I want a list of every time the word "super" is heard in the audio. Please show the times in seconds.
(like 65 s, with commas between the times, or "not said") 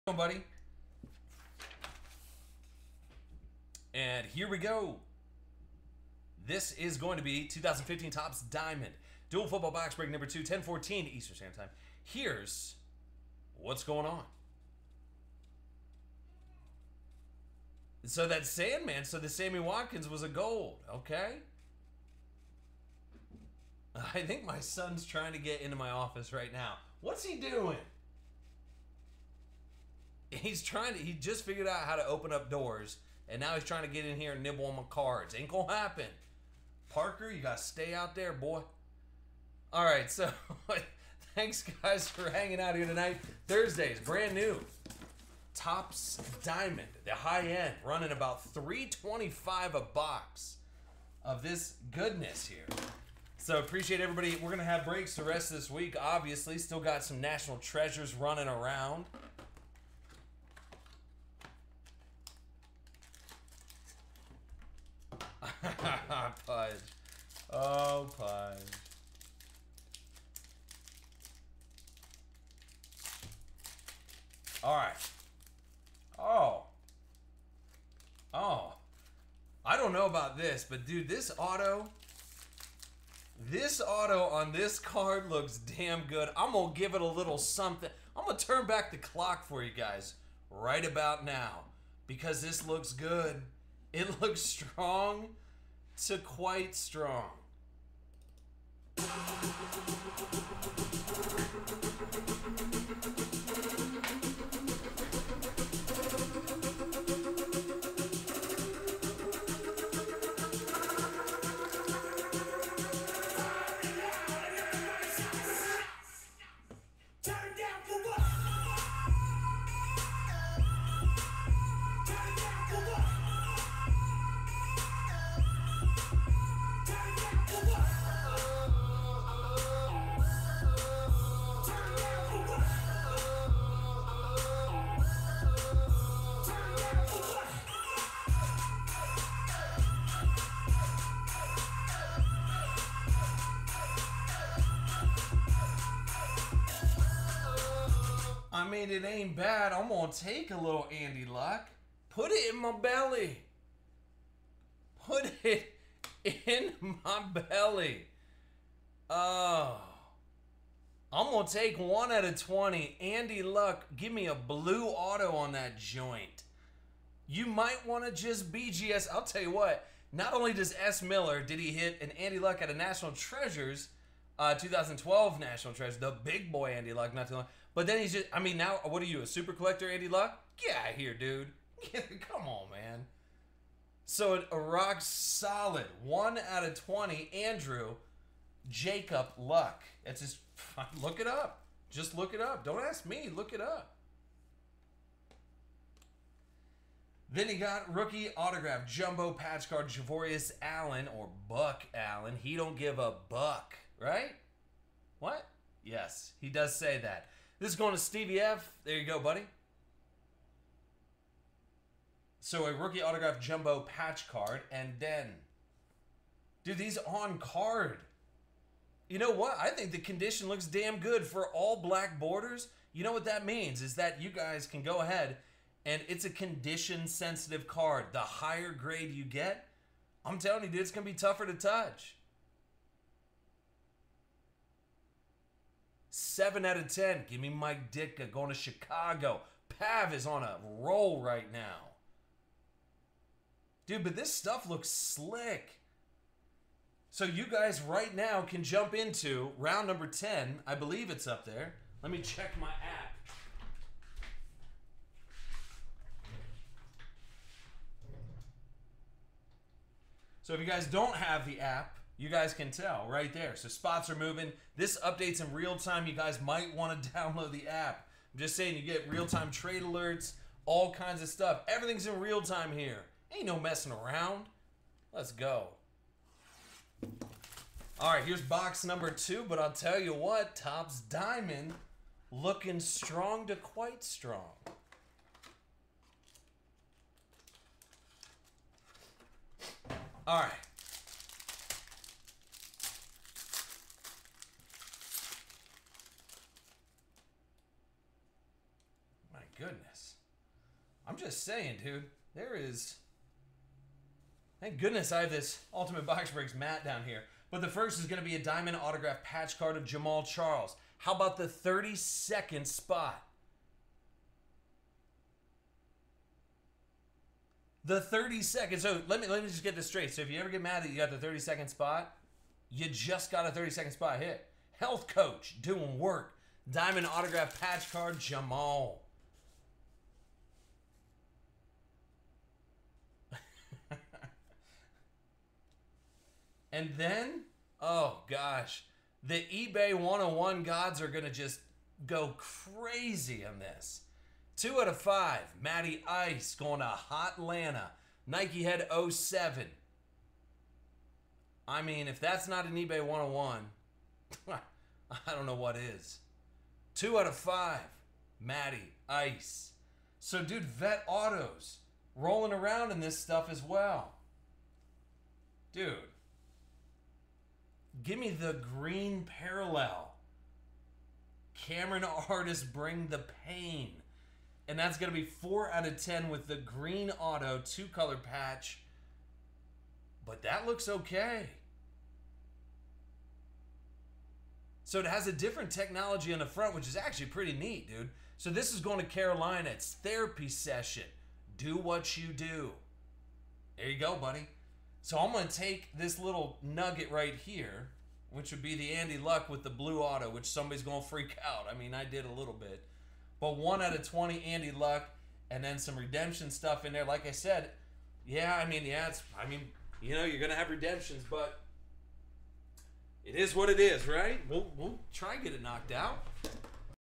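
179 s.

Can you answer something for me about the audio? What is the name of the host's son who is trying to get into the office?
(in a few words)
Parker.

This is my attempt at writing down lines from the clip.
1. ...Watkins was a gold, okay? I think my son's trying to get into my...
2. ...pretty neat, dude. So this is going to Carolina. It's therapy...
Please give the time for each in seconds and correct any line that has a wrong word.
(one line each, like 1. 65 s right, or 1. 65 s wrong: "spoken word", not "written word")
1. 19 s right
2. 387 s right.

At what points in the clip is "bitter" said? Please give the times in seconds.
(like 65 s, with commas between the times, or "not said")
not said.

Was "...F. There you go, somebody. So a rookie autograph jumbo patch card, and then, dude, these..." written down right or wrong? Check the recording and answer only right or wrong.
wrong.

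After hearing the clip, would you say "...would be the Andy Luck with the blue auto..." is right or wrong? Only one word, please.
right.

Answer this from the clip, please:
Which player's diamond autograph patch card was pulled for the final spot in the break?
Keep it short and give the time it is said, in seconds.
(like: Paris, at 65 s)
Jamaal Charles, at 309 s.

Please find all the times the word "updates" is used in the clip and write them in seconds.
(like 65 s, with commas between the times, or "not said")
265 s.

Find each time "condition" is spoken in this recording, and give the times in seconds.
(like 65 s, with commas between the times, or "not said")
219 s, 226 s.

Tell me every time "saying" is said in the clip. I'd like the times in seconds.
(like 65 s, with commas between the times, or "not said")
268 s, 301 s.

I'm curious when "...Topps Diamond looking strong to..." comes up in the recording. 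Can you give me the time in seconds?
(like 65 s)
280 s.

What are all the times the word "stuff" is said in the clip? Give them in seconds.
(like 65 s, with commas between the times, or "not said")
244 s, 271 s, 363 s, 406 s.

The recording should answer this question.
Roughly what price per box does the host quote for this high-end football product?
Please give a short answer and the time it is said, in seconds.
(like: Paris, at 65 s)
$325, at 48 s.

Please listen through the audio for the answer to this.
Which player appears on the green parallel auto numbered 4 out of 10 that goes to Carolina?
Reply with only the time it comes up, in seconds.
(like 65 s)
371 s.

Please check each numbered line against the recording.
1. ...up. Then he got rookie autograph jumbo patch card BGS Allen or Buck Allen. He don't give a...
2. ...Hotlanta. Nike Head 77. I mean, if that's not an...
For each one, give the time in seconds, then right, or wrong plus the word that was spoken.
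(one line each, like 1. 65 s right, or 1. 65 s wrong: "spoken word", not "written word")
1. 193 s wrong: "Javorius", not "BGS"
2. 347 s wrong: "07", not "77".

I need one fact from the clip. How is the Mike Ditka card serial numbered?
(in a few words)
7 out of 10.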